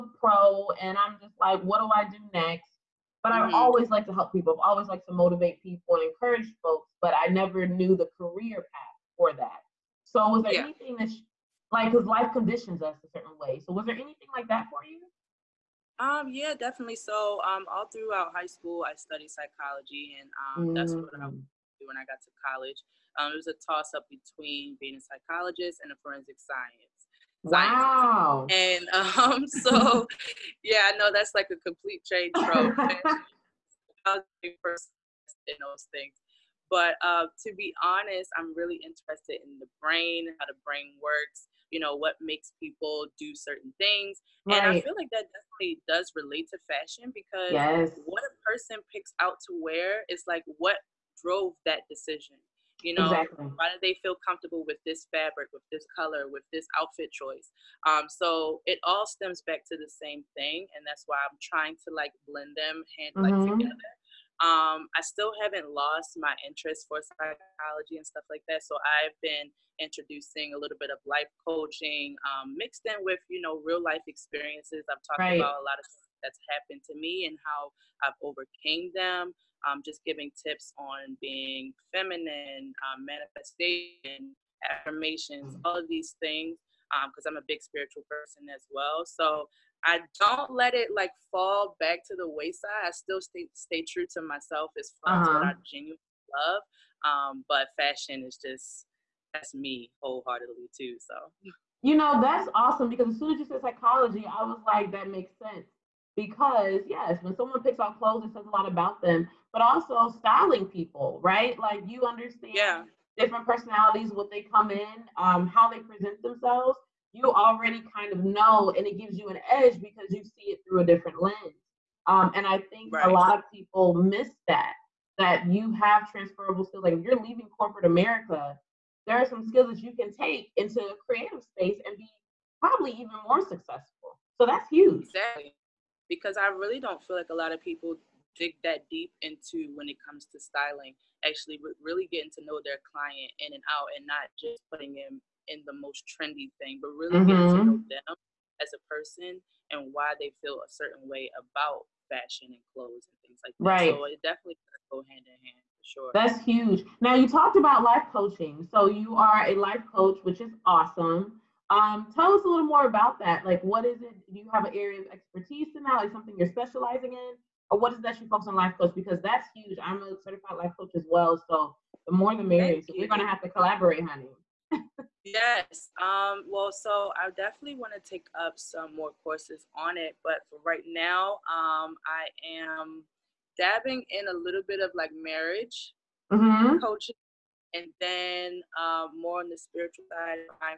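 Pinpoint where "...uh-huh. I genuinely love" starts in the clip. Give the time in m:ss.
1:35.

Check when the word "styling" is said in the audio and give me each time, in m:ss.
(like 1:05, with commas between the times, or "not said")
1:50, 2:20.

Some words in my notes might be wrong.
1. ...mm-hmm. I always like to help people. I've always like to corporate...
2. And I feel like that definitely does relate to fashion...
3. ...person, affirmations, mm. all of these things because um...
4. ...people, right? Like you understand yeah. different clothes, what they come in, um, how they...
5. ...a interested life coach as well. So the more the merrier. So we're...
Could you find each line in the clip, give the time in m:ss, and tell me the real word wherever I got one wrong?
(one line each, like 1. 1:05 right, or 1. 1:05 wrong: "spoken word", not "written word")
1. 0:03 wrong: "motivate", not "corporate"
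2. 0:44 right
3. 1:23 wrong: "manifestation", not "person"
4. 1:50 wrong: "personalities", not "clothes"
5. 2:50 wrong: "certified", not "interested".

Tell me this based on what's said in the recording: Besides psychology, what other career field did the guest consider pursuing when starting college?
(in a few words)
forensic science.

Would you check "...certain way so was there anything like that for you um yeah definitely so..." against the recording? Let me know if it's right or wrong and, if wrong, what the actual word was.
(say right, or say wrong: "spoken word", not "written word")
right.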